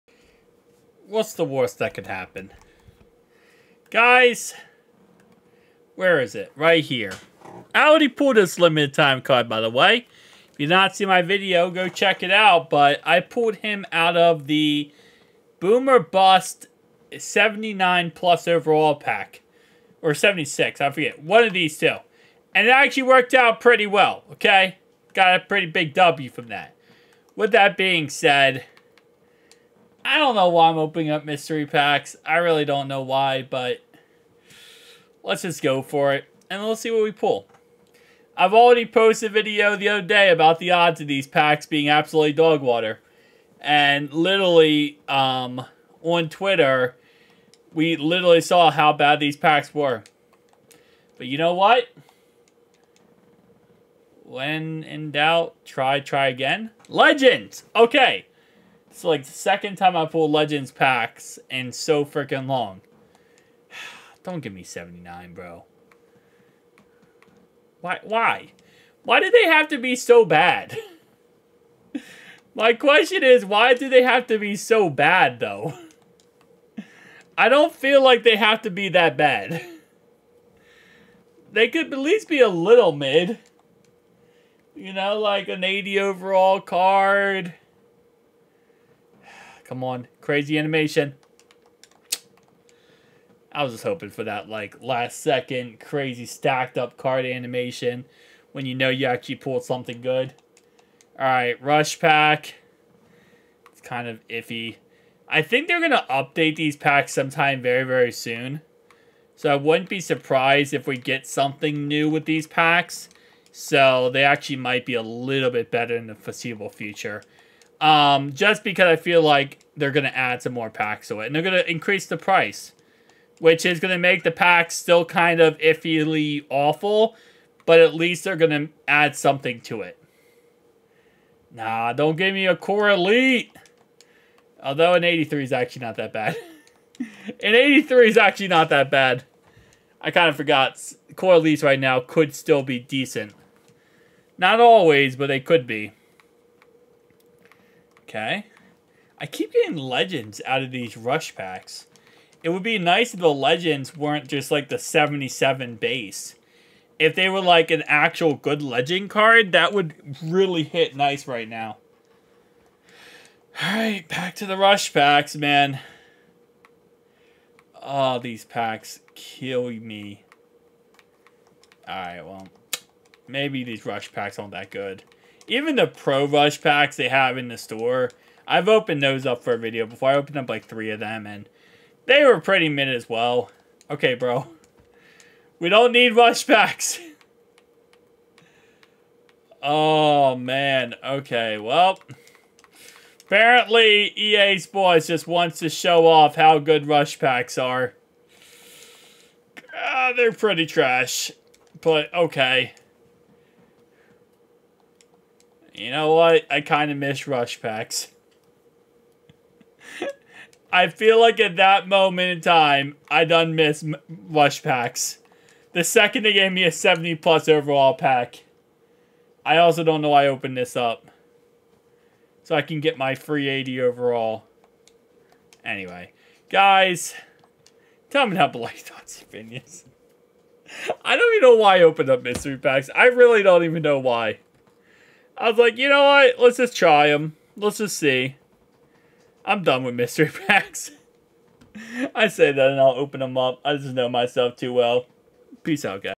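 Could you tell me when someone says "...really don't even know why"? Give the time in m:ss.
3:53.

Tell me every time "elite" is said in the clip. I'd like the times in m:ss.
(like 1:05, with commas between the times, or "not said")
2:12, 2:21.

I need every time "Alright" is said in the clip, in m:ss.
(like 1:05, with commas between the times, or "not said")
1:41, 2:43, 2:51.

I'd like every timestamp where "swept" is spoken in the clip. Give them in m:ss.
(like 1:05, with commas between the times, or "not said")
not said.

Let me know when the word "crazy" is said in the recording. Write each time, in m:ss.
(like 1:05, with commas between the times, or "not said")
1:30, 1:35.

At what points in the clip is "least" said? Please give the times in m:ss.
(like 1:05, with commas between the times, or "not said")
1:21, 2:07.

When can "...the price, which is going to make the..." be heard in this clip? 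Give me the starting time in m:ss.
2:02.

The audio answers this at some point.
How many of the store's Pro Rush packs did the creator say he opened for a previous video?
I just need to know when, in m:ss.
3:00.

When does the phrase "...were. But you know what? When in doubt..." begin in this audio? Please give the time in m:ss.
0:49.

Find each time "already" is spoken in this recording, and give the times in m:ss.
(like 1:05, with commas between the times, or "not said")
0:07, 0:38.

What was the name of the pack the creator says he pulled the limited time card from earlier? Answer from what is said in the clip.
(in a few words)
Boomer Bust.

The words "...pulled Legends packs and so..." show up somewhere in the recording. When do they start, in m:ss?
1:00.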